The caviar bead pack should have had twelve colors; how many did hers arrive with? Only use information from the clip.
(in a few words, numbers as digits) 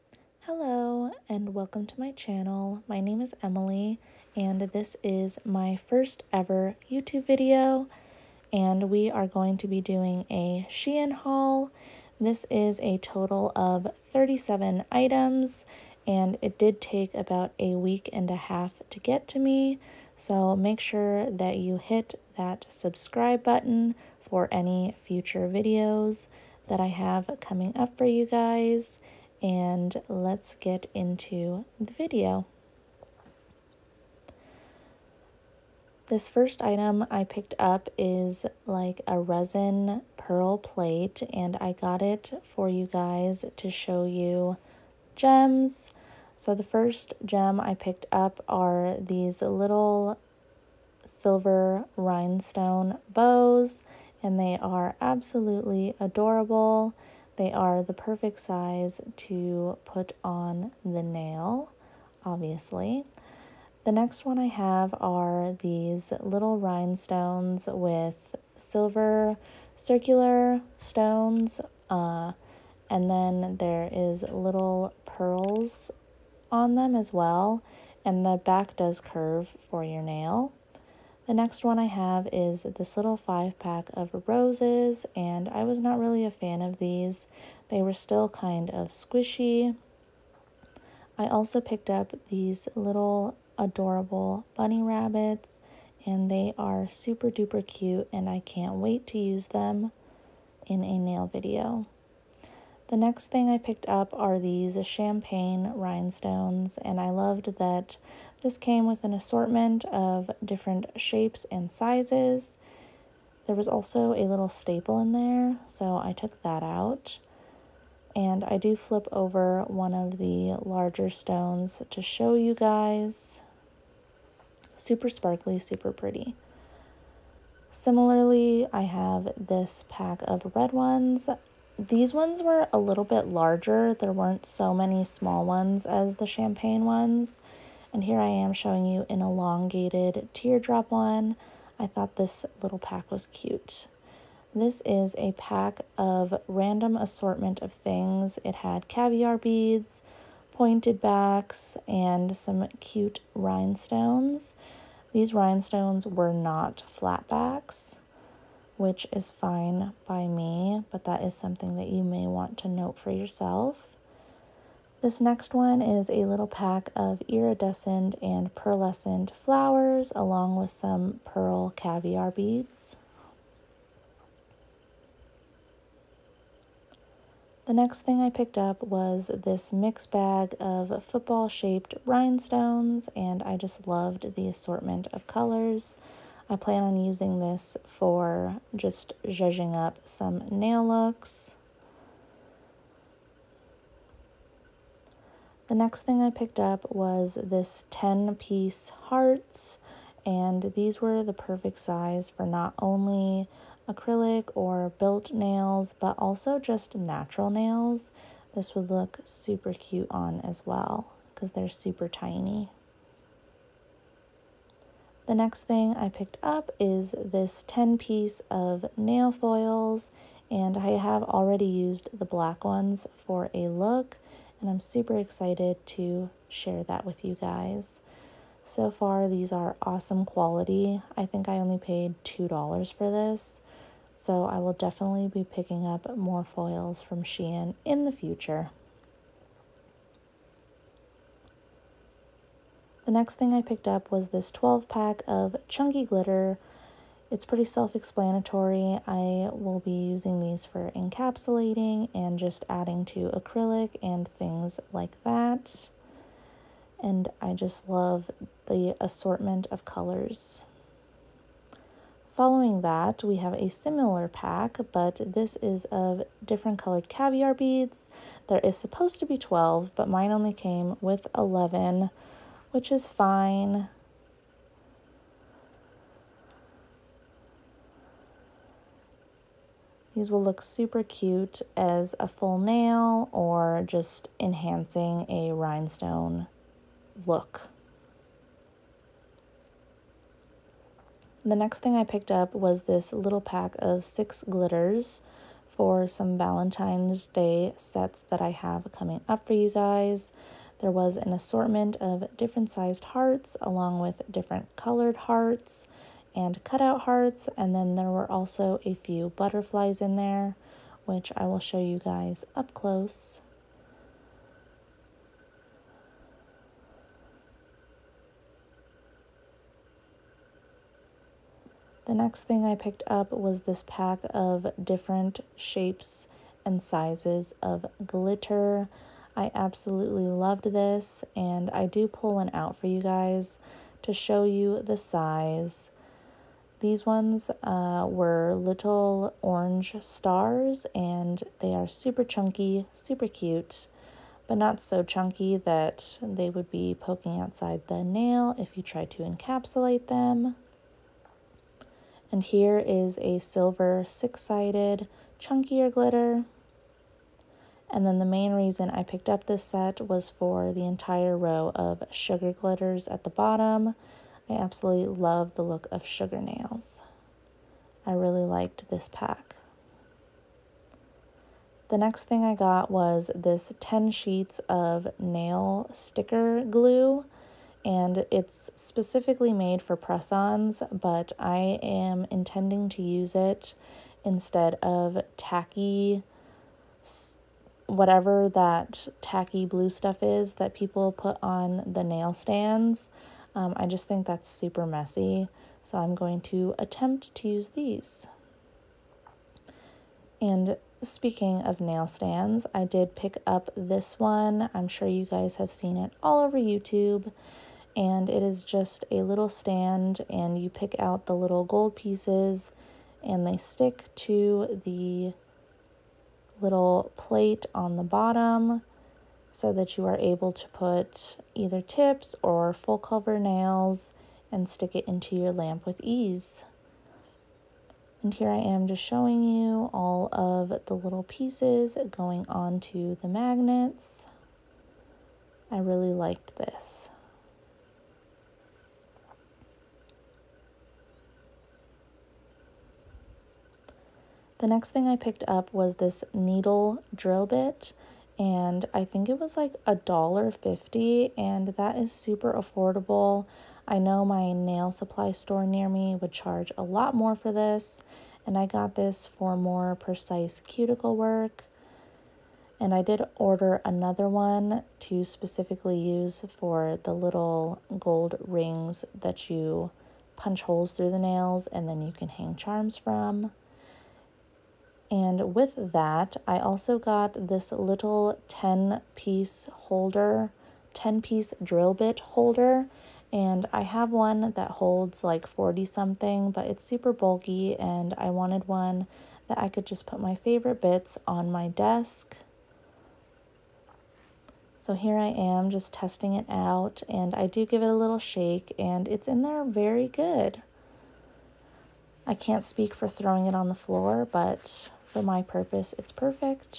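11.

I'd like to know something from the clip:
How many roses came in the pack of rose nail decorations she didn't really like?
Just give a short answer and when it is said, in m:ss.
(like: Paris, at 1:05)
5, at 1:23.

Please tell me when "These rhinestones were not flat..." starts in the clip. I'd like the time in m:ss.
2:35.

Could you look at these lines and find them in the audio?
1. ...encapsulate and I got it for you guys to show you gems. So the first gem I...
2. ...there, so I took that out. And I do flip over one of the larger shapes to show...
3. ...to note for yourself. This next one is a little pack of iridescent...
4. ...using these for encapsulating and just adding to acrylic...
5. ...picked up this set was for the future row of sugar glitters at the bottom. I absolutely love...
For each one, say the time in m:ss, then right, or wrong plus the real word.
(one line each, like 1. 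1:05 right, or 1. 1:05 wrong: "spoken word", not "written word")
1. 0:40 wrong: "plate", not "encapsulate"
2. 1:55 wrong: "stones", not "shapes"
3. 2:42 right
4. 4:09 right
5. 5:59 wrong: "entire", not "future".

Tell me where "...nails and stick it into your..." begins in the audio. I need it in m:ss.
7:03.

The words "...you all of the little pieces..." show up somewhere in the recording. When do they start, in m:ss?
7:09.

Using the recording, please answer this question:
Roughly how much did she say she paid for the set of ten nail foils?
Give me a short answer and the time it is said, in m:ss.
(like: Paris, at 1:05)
$2, at 3:52.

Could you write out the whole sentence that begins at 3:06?
I plan on using this for just zhuzhing up some nail looks.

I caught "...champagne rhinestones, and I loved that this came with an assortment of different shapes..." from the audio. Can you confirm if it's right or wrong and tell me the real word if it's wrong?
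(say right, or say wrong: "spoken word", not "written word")
right.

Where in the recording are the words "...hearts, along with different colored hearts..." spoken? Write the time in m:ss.
5:03.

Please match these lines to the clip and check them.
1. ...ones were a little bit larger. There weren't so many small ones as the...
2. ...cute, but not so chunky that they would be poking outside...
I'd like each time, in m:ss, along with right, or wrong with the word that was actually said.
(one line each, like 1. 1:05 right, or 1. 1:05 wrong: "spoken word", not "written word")
1. 2:12 right
2. 5:43 right.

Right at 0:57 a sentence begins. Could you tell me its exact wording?
They are the perfect size to put on the nail, obviously.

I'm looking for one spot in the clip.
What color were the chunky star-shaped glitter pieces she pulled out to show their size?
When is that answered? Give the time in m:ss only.
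5:39.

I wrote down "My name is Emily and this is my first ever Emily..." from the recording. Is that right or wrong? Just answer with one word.
wrong.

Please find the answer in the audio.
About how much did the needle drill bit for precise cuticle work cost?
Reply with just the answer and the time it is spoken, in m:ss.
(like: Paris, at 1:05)
a dollar fifty, at 7:29.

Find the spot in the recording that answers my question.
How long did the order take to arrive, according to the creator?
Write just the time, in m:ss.
0:17.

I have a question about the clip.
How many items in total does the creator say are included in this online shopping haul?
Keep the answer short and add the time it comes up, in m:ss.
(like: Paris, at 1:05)
37, at 0:14.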